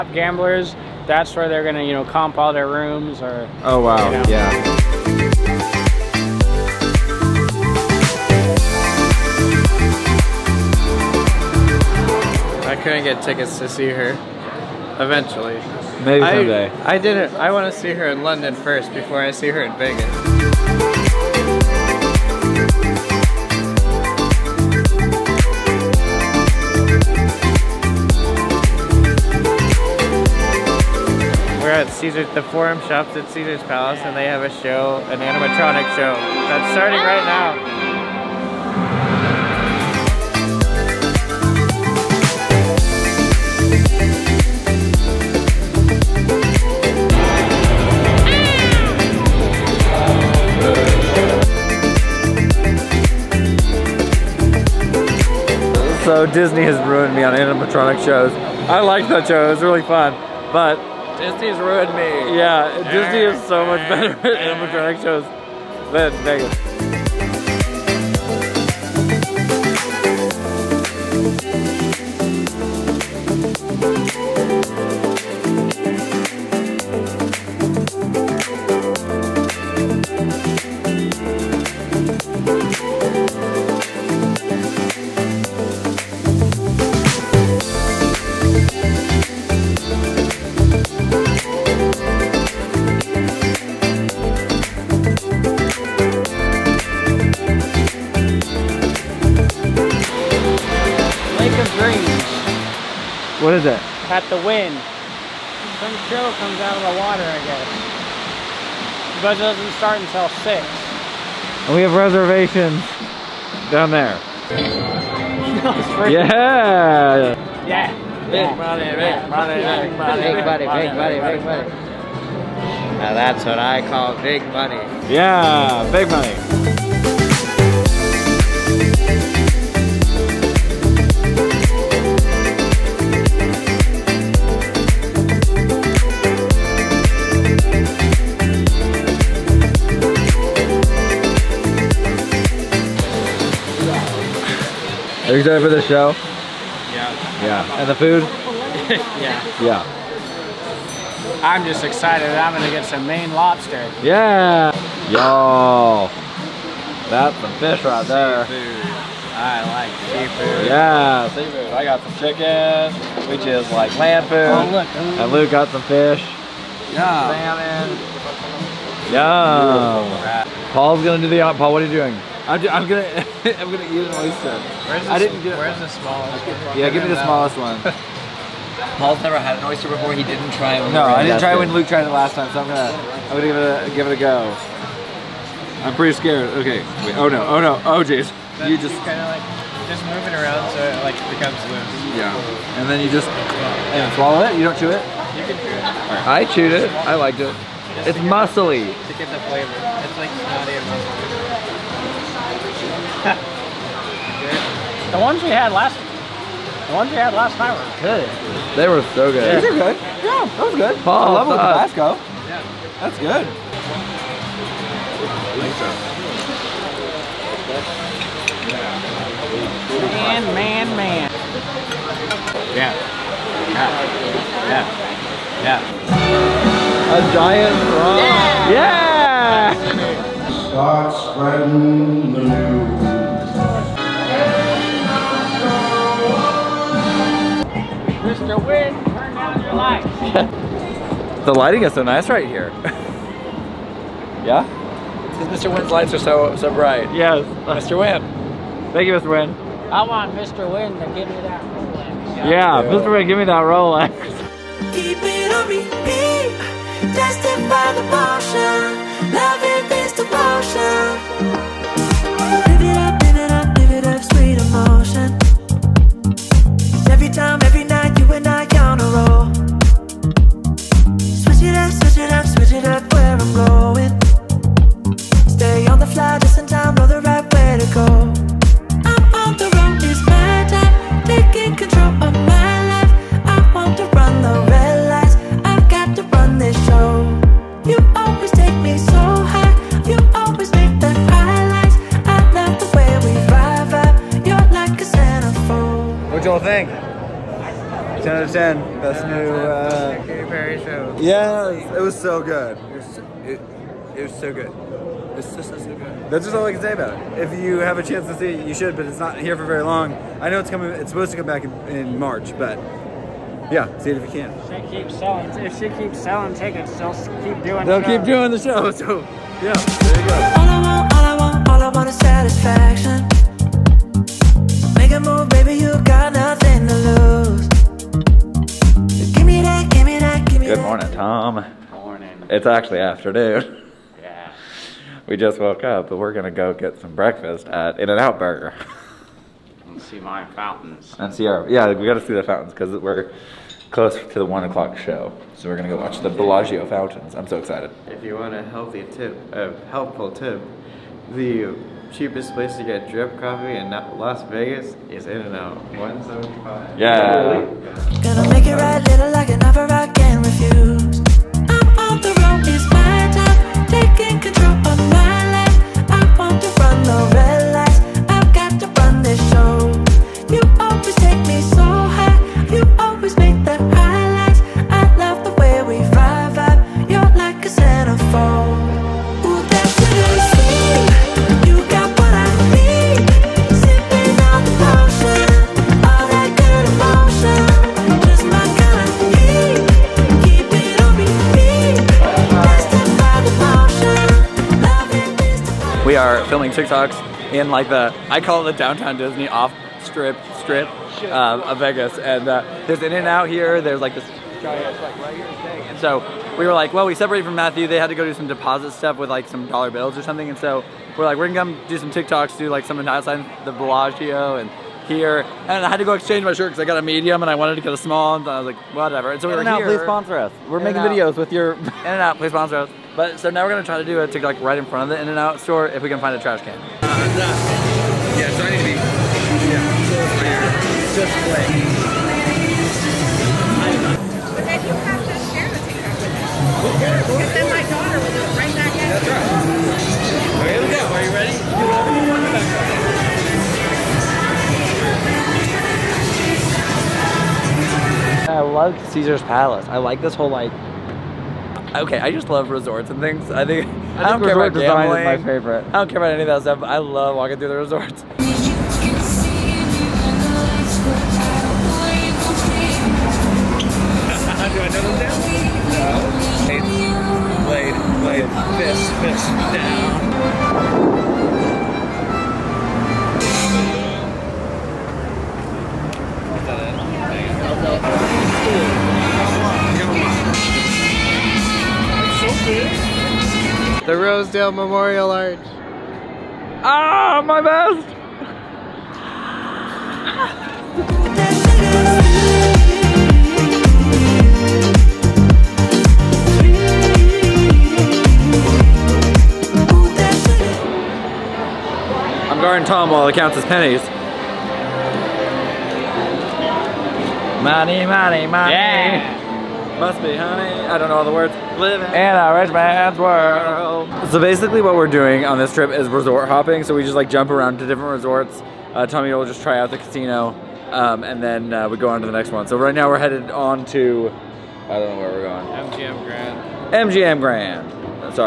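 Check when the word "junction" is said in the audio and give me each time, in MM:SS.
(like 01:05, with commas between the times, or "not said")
not said.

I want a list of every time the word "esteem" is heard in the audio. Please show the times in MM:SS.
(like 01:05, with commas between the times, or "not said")
not said.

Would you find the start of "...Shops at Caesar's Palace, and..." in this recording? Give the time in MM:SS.
00:32.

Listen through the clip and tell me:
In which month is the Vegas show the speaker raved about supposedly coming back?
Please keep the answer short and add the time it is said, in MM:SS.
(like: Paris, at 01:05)
March, at 05:12.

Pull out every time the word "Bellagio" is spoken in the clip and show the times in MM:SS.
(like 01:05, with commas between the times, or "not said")
05:46, 06:53.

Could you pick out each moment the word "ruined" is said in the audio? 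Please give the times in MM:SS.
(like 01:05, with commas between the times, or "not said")
00:56, 01:01.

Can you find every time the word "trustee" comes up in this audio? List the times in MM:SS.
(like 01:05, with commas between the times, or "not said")
not said.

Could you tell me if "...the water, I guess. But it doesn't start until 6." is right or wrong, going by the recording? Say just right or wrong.
right.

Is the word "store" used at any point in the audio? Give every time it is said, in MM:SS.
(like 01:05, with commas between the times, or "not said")
07:05.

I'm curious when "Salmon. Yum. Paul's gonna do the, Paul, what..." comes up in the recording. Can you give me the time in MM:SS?
02:49.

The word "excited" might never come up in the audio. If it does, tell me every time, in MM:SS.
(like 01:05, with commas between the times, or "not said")
02:25, 02:31, 05:47.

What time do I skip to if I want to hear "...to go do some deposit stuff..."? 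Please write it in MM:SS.
06:48.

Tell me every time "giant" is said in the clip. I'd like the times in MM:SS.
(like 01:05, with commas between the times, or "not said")
03:47, 06:44.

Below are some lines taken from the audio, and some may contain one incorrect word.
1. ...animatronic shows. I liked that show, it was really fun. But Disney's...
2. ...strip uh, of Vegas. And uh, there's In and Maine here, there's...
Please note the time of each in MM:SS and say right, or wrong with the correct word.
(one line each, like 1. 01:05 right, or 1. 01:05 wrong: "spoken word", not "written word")
1. 00:57 right
2. 06:40 wrong: "Out", not "Maine".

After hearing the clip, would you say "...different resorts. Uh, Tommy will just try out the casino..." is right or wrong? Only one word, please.
right.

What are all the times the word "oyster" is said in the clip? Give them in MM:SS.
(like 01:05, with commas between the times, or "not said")
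02:54, 02:59.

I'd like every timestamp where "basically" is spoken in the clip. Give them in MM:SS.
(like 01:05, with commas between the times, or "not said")
08:34.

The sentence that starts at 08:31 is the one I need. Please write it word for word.
Living in a rich man's world.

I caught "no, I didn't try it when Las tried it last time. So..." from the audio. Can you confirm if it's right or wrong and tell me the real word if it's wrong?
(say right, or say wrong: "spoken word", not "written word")
wrong: "Luke", not "Las".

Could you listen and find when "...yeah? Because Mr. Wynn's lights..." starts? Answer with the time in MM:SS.
04:04.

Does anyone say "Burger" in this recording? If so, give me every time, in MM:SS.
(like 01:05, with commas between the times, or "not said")
05:38.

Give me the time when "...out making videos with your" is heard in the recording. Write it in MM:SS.
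07:00.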